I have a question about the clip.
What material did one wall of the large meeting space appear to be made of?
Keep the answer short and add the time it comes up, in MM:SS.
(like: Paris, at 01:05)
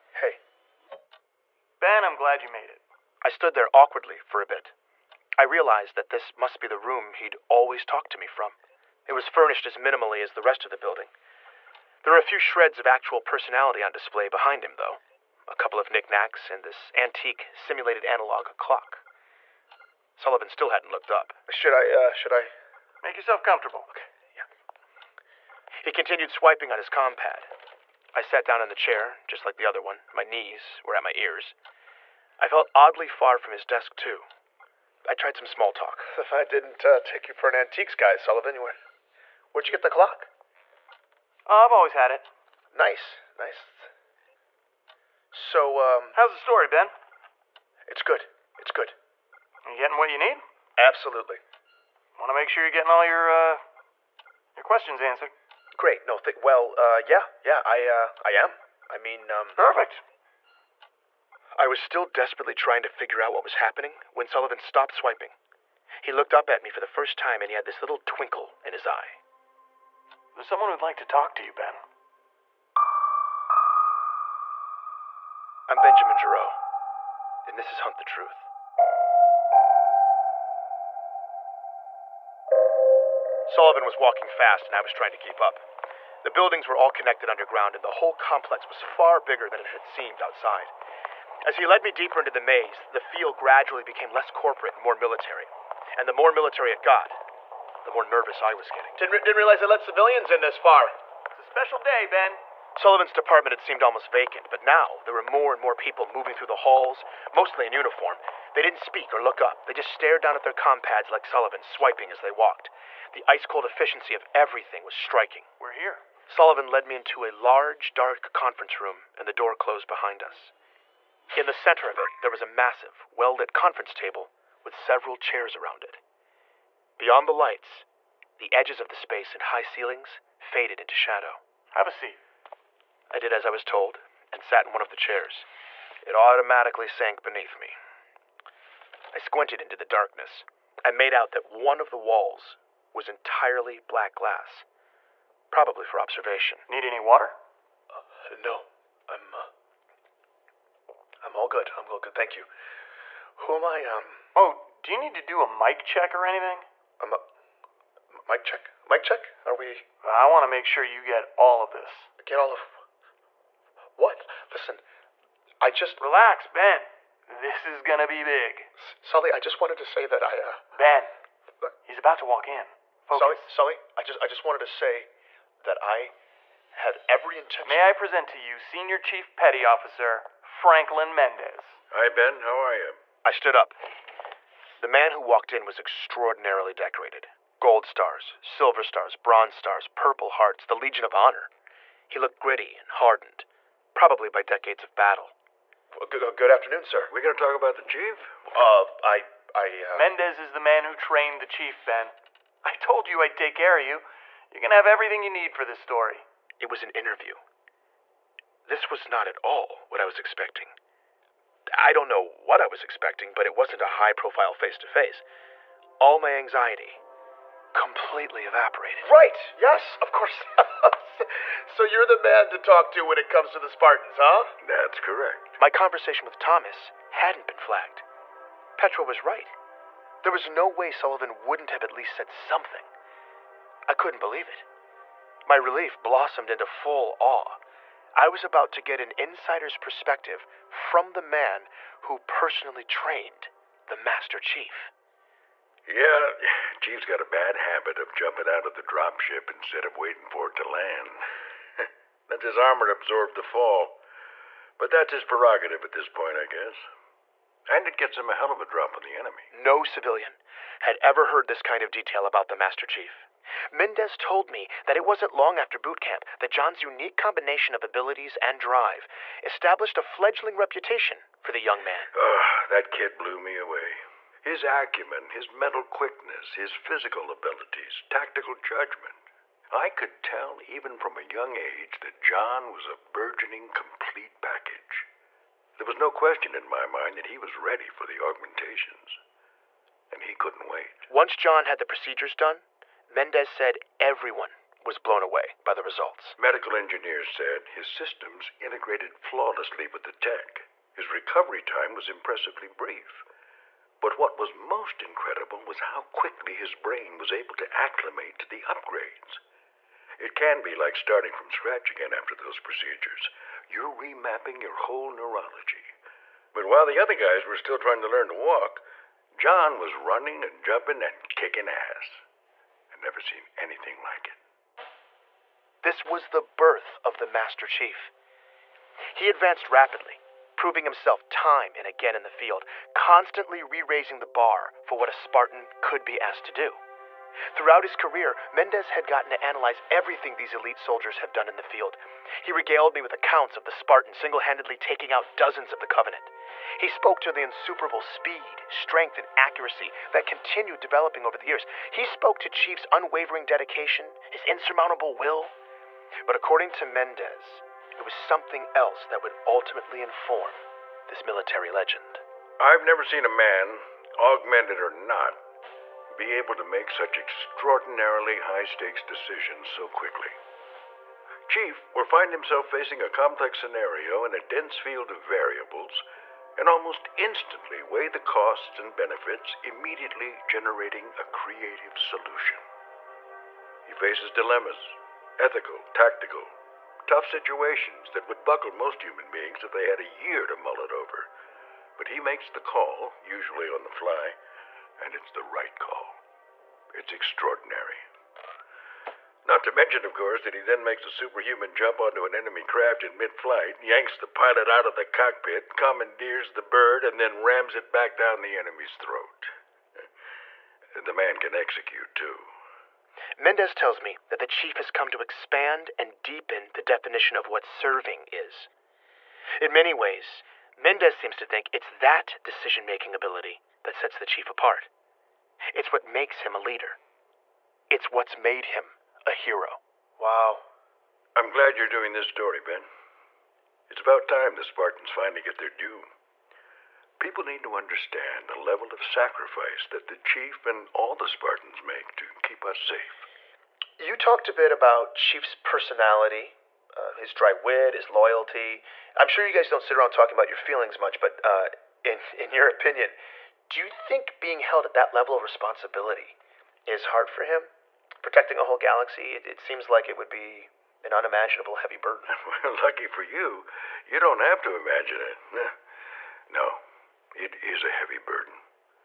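black glass, at 02:23.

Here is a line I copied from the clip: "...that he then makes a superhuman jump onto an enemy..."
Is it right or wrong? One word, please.
right.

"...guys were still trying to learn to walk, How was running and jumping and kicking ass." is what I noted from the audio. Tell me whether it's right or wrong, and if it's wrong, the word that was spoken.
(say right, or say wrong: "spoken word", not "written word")
wrong: "John", not "How".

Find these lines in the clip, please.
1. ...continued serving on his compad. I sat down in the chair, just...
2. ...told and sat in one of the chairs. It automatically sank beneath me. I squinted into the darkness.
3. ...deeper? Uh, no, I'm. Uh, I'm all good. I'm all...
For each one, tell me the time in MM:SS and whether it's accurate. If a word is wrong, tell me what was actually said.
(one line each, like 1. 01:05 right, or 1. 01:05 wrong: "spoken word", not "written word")
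1. 00:25 wrong: "swiping", not "serving"
2. 02:13 right
3. 02:26 wrong: "water", not "deeper".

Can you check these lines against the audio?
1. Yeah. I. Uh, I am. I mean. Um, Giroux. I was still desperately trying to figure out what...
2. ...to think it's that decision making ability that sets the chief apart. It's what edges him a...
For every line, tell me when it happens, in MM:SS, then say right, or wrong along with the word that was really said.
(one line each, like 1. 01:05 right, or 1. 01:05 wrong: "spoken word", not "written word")
1. 00:57 wrong: "Perfect", not "Giroux"
2. 07:01 wrong: "makes", not "edges".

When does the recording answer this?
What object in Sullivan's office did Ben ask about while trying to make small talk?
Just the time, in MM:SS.
00:16.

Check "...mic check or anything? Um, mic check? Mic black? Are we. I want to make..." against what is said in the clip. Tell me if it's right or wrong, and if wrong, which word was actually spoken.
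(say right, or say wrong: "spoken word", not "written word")
wrong: "check", not "black".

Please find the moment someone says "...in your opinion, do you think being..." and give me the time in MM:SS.
07:32.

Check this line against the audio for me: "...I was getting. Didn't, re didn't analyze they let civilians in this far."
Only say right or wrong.
wrong.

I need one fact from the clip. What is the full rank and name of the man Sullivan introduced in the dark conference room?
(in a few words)
Senior Chief Petty Officer Franklin Mendez.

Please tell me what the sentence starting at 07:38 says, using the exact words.
protecting a whole galaxy, it, it seems like it would be an unimaginable heavy burden.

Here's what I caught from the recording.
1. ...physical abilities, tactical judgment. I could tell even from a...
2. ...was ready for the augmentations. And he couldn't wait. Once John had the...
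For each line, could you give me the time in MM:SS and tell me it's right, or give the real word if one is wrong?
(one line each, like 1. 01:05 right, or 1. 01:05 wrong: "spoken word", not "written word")
1. 04:36 right
2. 04:47 right.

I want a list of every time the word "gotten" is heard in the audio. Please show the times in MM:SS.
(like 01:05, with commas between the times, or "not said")
05:39.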